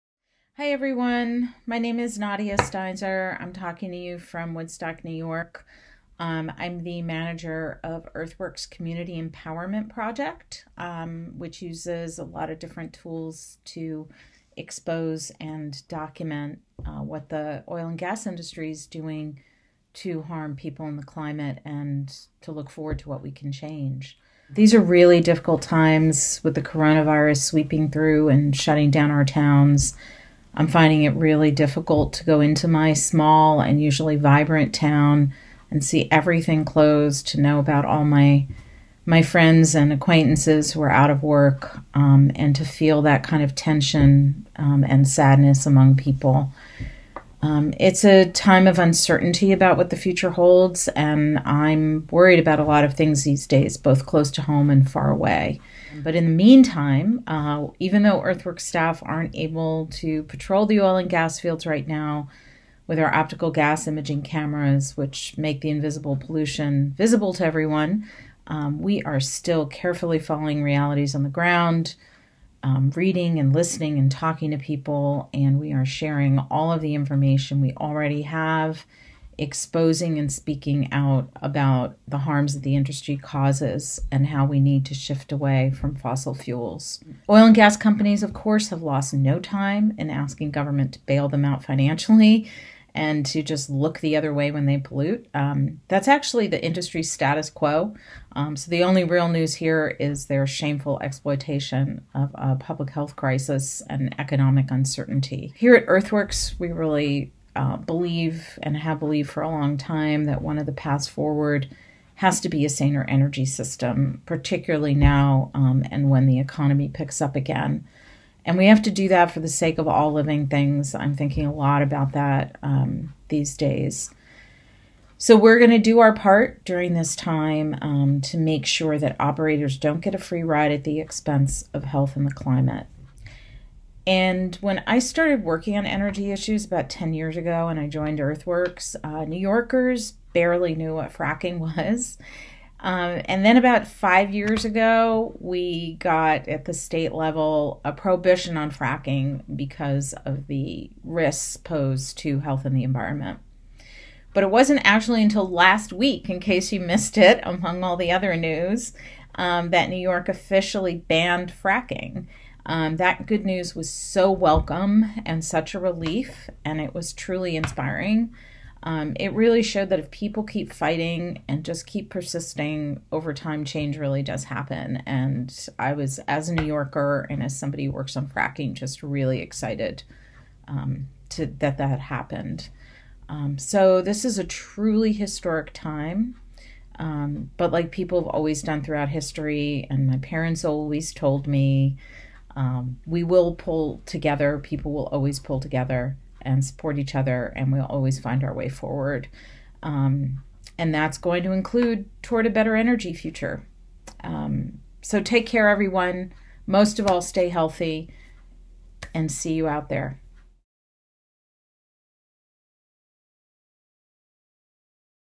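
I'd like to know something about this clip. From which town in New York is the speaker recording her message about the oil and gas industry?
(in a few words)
Woodstock.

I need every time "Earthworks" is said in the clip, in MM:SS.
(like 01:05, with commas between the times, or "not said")
00:08, 00:58, 01:45, 02:18.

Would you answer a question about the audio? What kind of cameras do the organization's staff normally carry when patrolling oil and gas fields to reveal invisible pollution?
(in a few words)
Optical gas imaging cameras.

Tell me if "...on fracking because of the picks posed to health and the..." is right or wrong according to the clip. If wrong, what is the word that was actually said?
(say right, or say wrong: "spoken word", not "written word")
wrong: "risks", not "picks".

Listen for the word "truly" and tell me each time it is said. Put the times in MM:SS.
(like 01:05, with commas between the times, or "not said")
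02:47, 03:04.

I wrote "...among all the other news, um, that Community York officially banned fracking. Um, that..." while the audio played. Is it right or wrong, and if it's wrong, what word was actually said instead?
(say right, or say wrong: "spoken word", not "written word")
wrong: "New", not "Community".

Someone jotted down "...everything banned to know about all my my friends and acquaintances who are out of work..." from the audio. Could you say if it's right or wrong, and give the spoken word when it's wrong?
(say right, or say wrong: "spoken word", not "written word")
wrong: "closed", not "banned".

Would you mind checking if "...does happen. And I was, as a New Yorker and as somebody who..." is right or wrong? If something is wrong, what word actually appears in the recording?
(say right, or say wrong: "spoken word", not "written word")
right.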